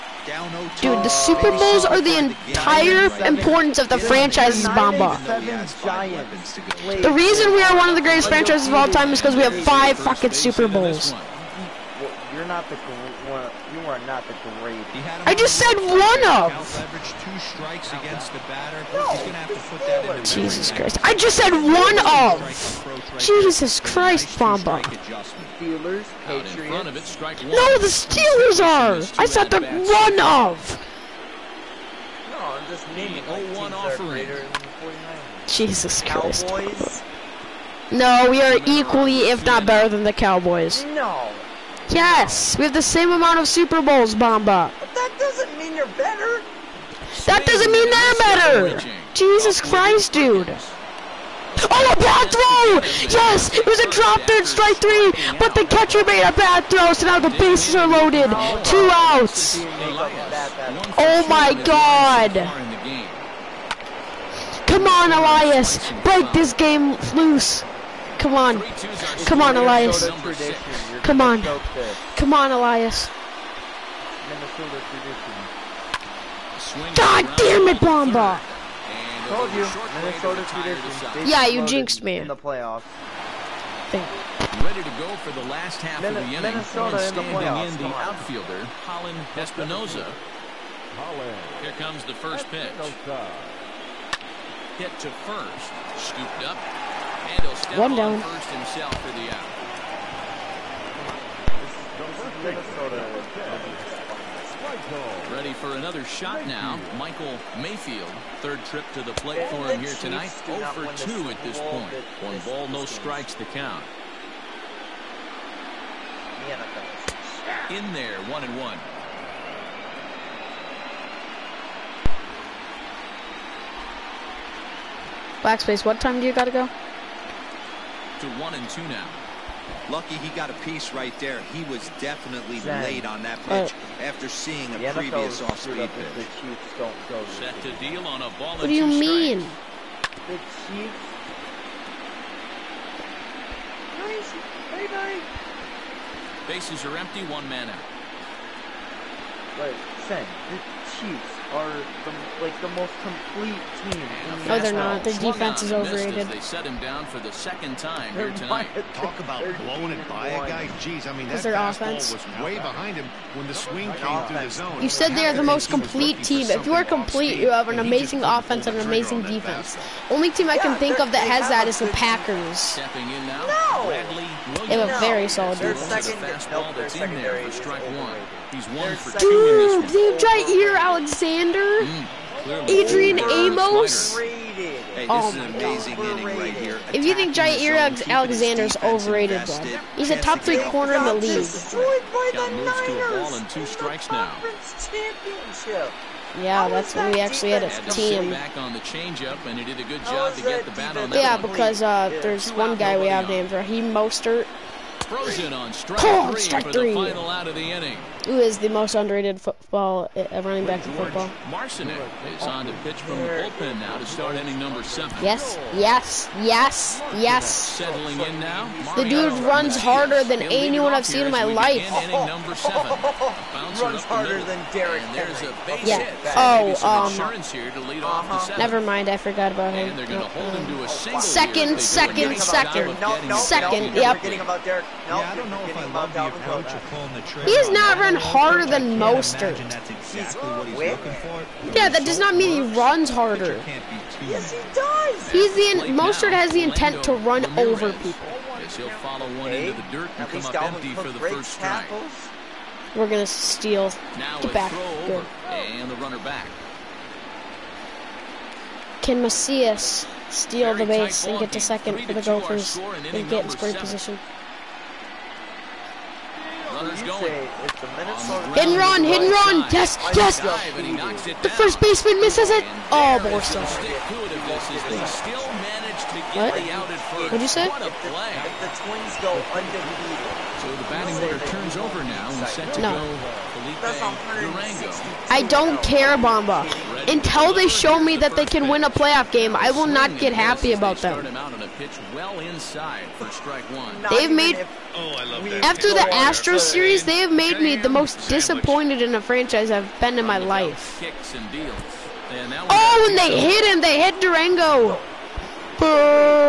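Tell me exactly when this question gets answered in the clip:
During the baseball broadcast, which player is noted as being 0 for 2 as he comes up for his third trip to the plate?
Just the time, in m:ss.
1:46.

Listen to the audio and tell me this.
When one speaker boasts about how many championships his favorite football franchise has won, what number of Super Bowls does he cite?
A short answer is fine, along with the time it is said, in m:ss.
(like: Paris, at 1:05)
5, at 0:09.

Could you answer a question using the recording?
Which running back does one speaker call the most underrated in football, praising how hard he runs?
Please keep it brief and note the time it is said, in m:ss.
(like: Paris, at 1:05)
Raheem Mostert, at 3:23.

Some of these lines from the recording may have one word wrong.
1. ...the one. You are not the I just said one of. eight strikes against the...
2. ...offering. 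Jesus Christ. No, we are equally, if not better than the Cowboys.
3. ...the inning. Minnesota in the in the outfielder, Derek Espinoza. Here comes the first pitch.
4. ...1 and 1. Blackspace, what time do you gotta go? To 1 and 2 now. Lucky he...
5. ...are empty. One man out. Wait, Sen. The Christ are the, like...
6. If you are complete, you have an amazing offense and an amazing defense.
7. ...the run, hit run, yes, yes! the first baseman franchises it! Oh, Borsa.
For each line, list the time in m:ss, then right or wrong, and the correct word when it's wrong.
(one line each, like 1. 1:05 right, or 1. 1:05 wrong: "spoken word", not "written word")
1. 0:12 wrong: "two", not "eight"
2. 0:33 right
3. 1:26 wrong: "Holland", not "Derek"
4. 1:58 right
5. 2:26 wrong: "Chiefs", not "Christ"
6. 2:46 right
7. 4:27 wrong: "misses", not "franchises".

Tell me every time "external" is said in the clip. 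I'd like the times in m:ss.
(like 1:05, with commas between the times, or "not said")
not said.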